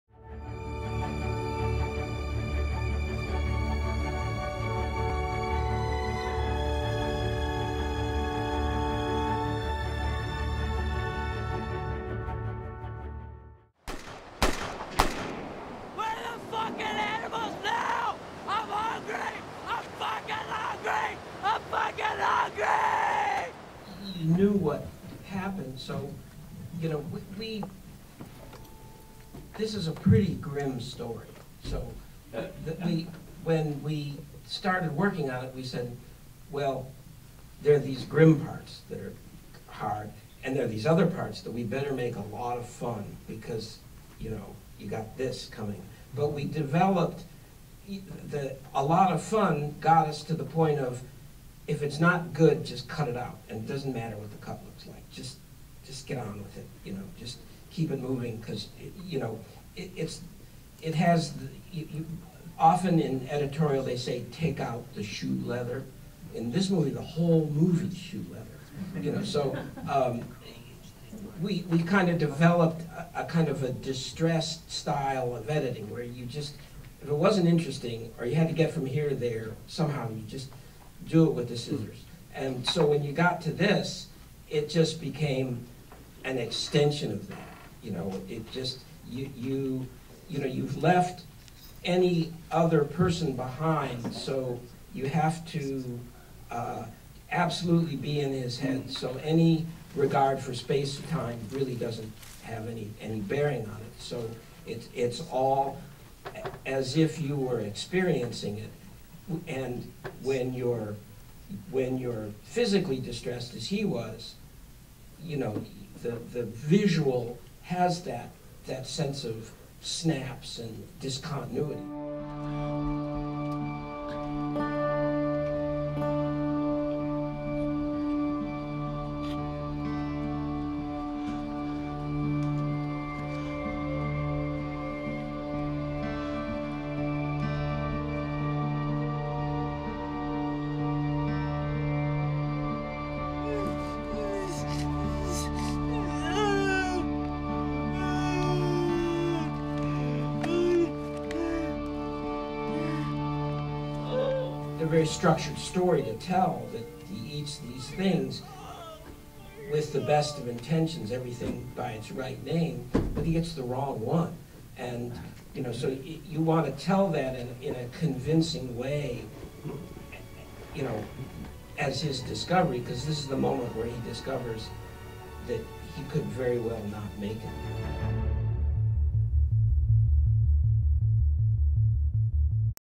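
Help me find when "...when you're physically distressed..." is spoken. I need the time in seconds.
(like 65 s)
111 s.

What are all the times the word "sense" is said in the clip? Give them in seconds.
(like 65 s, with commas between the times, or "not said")
118 s.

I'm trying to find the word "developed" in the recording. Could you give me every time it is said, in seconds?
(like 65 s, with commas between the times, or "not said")
46 s, 72 s.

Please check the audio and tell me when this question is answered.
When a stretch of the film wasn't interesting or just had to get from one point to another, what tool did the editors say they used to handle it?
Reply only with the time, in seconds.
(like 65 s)
81 s.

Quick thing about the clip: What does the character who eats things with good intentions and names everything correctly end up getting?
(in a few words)
the wrong one.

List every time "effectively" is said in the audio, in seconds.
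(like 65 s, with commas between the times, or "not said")
not said.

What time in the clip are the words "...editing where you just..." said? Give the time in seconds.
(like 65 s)
75 s.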